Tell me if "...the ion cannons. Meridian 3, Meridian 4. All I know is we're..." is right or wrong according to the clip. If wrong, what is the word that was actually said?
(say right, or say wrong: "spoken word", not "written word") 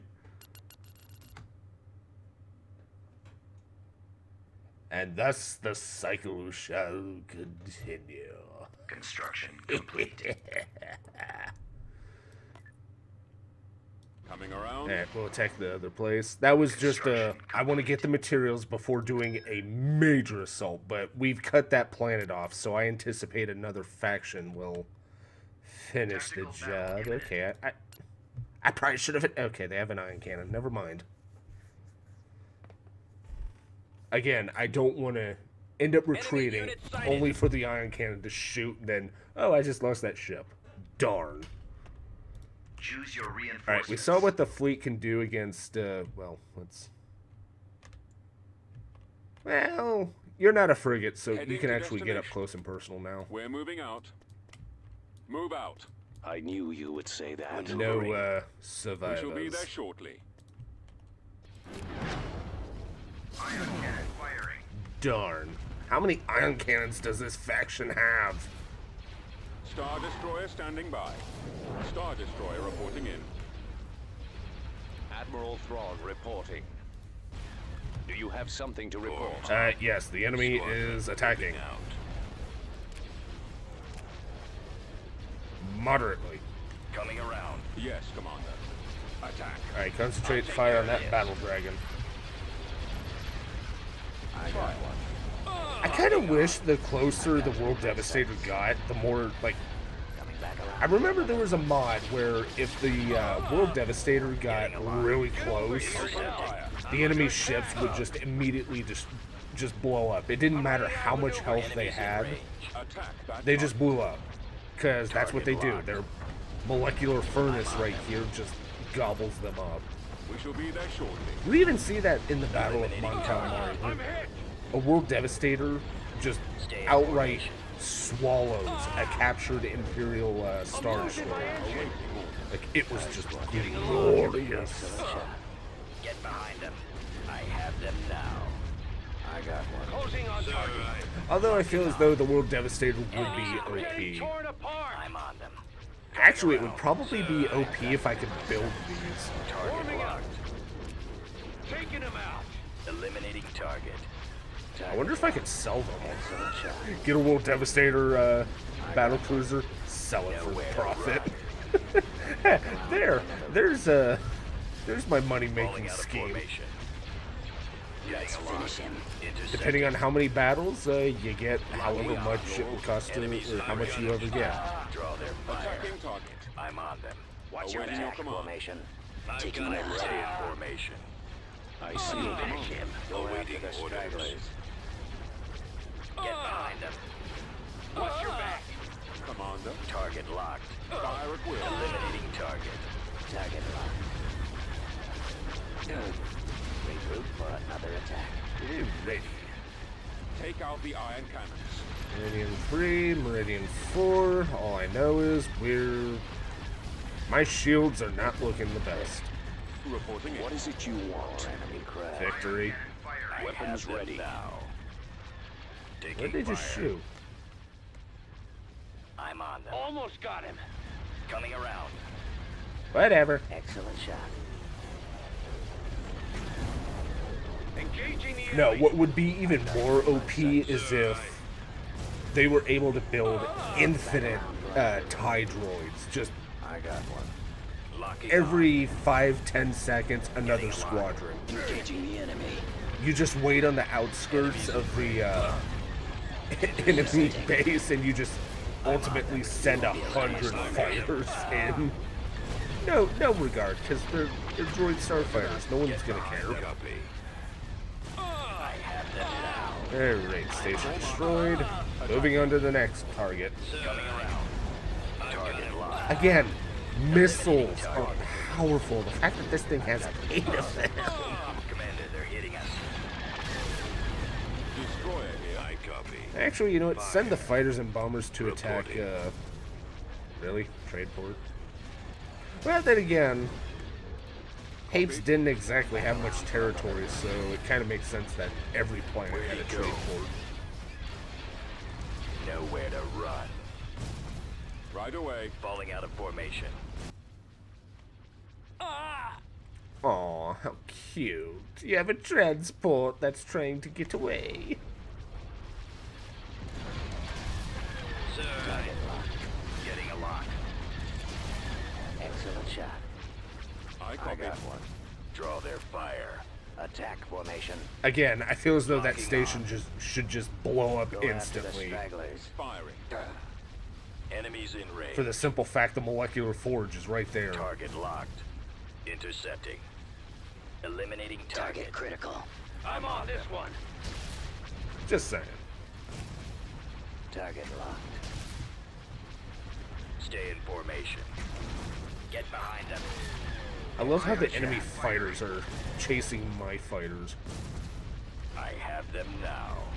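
right.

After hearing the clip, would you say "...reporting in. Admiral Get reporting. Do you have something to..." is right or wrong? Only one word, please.
wrong.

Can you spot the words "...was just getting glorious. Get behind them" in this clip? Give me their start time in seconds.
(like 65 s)
132 s.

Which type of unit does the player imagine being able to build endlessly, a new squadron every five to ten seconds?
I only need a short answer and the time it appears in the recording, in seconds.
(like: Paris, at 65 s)
TIE droids, at 235 s.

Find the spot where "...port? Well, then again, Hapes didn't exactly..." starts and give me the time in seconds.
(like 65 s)
281 s.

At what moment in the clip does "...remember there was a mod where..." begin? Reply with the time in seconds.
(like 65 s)
100 s.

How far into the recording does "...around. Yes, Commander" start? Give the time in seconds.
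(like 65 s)
87 s.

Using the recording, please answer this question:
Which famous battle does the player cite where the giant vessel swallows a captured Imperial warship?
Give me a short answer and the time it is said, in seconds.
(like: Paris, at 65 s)
Battle of Mon Cal, at 122 s.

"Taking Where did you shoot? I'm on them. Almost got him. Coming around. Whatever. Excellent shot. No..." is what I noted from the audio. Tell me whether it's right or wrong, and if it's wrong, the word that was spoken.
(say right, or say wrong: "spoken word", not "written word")
right.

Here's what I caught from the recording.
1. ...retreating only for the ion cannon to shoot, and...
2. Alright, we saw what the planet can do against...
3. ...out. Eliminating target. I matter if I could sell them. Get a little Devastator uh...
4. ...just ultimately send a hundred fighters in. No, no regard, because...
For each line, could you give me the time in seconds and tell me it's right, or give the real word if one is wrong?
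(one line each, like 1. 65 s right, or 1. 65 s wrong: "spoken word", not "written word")
1. 36 s right
2. 43 s wrong: "fleet", not "planet"
3. 152 s wrong: "wonder", not "matter"
4. 248 s right.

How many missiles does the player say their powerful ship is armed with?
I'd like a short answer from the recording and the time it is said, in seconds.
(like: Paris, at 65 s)
8, at 270 s.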